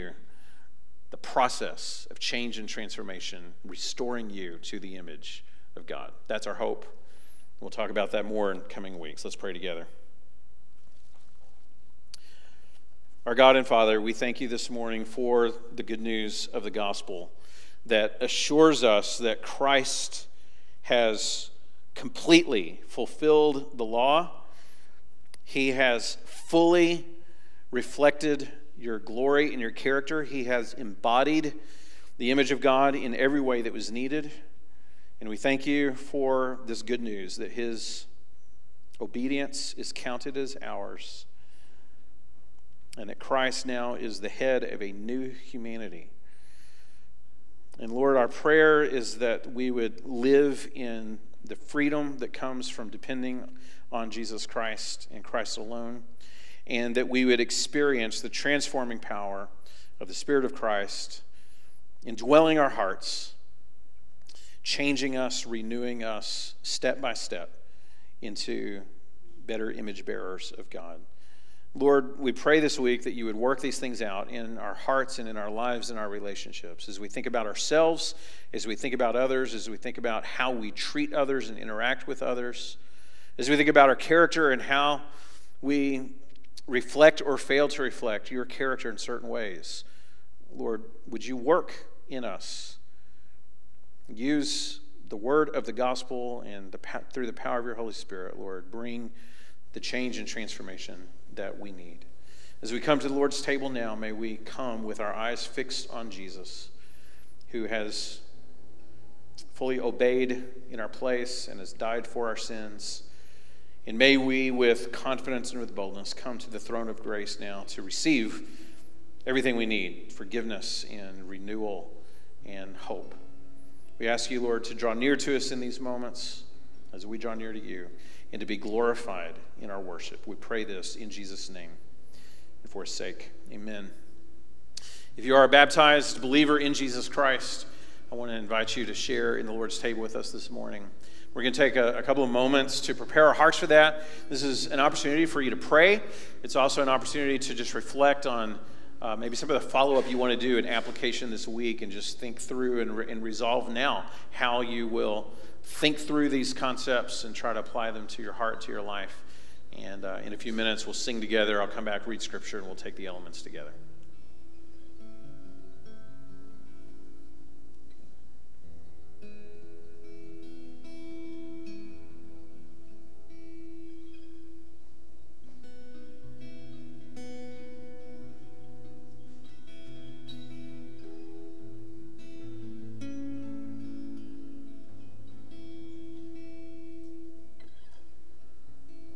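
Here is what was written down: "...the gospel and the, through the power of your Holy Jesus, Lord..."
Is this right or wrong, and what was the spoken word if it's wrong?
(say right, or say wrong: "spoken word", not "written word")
wrong: "Spirit", not "Jesus".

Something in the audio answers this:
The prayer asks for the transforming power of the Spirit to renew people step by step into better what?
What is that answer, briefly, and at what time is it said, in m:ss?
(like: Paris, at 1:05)
image bearers of God, at 1:09.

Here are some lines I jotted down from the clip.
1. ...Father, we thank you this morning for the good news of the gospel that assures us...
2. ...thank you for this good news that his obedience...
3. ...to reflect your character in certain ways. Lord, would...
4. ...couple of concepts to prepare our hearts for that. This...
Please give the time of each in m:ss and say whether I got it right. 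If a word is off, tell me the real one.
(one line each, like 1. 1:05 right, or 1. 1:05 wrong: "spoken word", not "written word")
1. 0:13 right
2. 0:35 right
3. 1:27 right
4. 2:22 wrong: "moments", not "concepts".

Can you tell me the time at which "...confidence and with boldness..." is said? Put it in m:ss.
1:54.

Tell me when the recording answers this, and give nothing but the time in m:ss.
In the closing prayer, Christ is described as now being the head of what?
0:44.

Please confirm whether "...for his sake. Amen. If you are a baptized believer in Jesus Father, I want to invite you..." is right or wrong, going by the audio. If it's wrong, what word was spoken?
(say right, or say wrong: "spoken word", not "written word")
wrong: "Christ", not "Father".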